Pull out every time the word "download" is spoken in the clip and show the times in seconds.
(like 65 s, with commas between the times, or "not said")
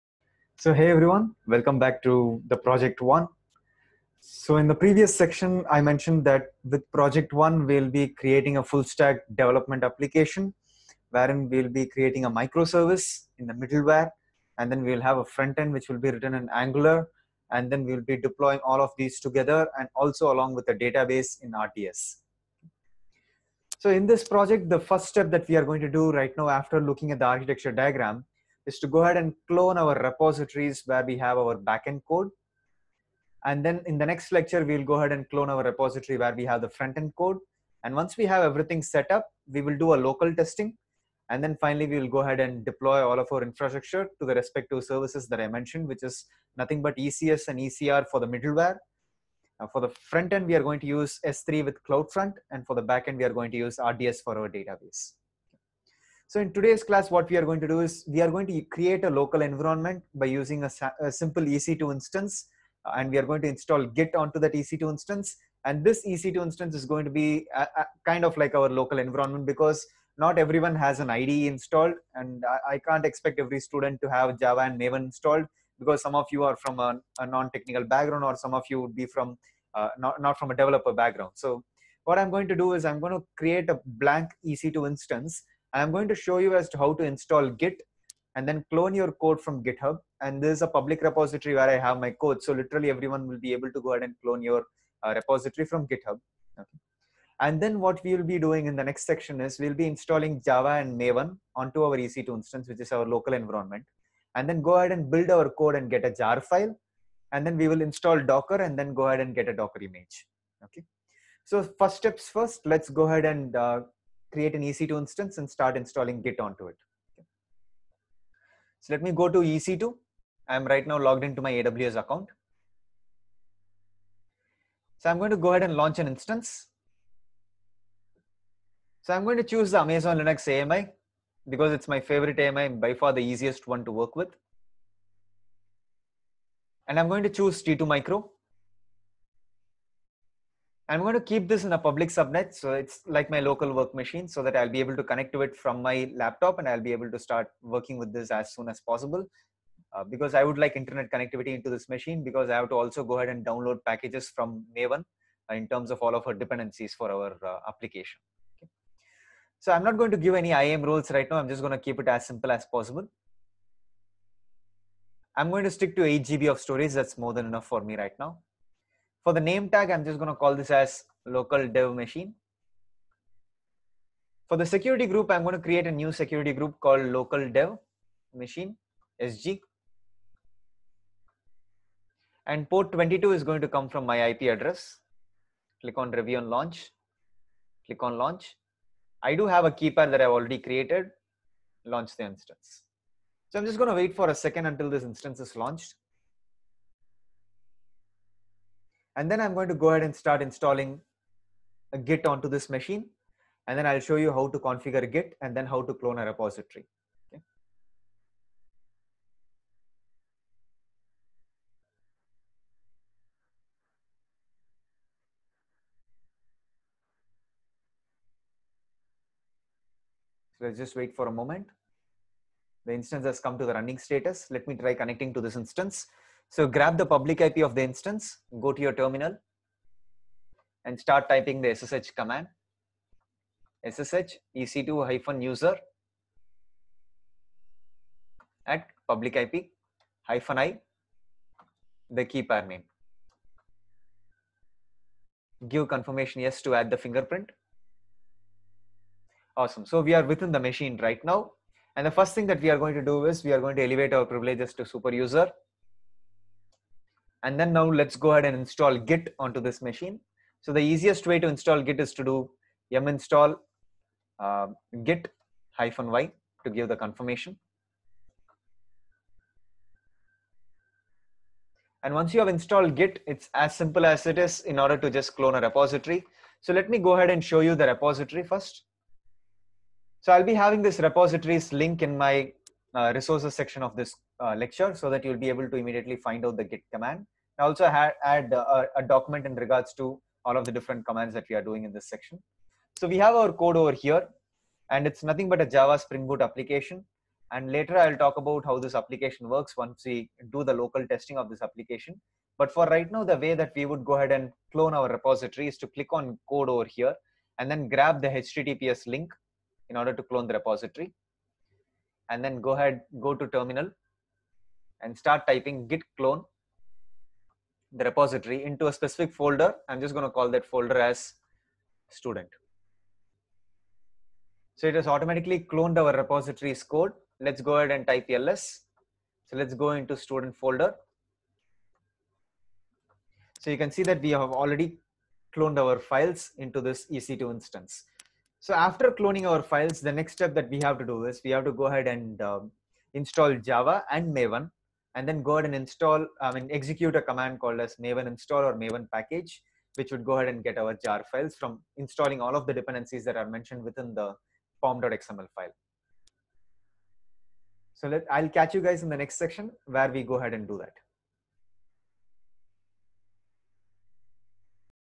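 153 s.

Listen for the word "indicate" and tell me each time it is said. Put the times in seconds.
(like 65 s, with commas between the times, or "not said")
not said.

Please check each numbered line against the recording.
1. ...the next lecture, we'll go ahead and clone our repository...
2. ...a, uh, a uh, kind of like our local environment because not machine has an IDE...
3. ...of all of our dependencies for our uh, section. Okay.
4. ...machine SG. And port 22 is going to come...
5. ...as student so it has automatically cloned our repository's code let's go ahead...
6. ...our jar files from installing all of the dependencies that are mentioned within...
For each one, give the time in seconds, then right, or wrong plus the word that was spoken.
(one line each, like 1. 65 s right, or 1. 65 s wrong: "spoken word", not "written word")
1. 33 s right
2. 67 s wrong: "everyone", not "machine"
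3. 155 s wrong: "application", not "section"
4. 178 s right
5. 321 s right
6. 350 s right.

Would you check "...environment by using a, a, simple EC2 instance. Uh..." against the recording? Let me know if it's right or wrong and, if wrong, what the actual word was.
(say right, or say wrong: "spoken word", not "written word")
right.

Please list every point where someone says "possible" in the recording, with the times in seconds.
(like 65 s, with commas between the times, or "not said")
148 s, 162 s.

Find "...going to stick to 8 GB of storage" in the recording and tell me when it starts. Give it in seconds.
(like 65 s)
165 s.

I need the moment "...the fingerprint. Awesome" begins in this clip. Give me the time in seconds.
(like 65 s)
246 s.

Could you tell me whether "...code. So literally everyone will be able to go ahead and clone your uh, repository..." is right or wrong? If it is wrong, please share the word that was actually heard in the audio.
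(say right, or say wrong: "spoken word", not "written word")
right.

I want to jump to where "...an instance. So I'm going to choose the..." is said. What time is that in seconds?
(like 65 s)
125 s.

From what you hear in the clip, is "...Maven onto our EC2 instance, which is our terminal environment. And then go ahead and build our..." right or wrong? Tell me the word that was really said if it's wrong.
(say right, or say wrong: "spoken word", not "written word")
wrong: "local", not "terminal".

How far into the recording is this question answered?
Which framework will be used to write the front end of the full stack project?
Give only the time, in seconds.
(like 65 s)
16 s.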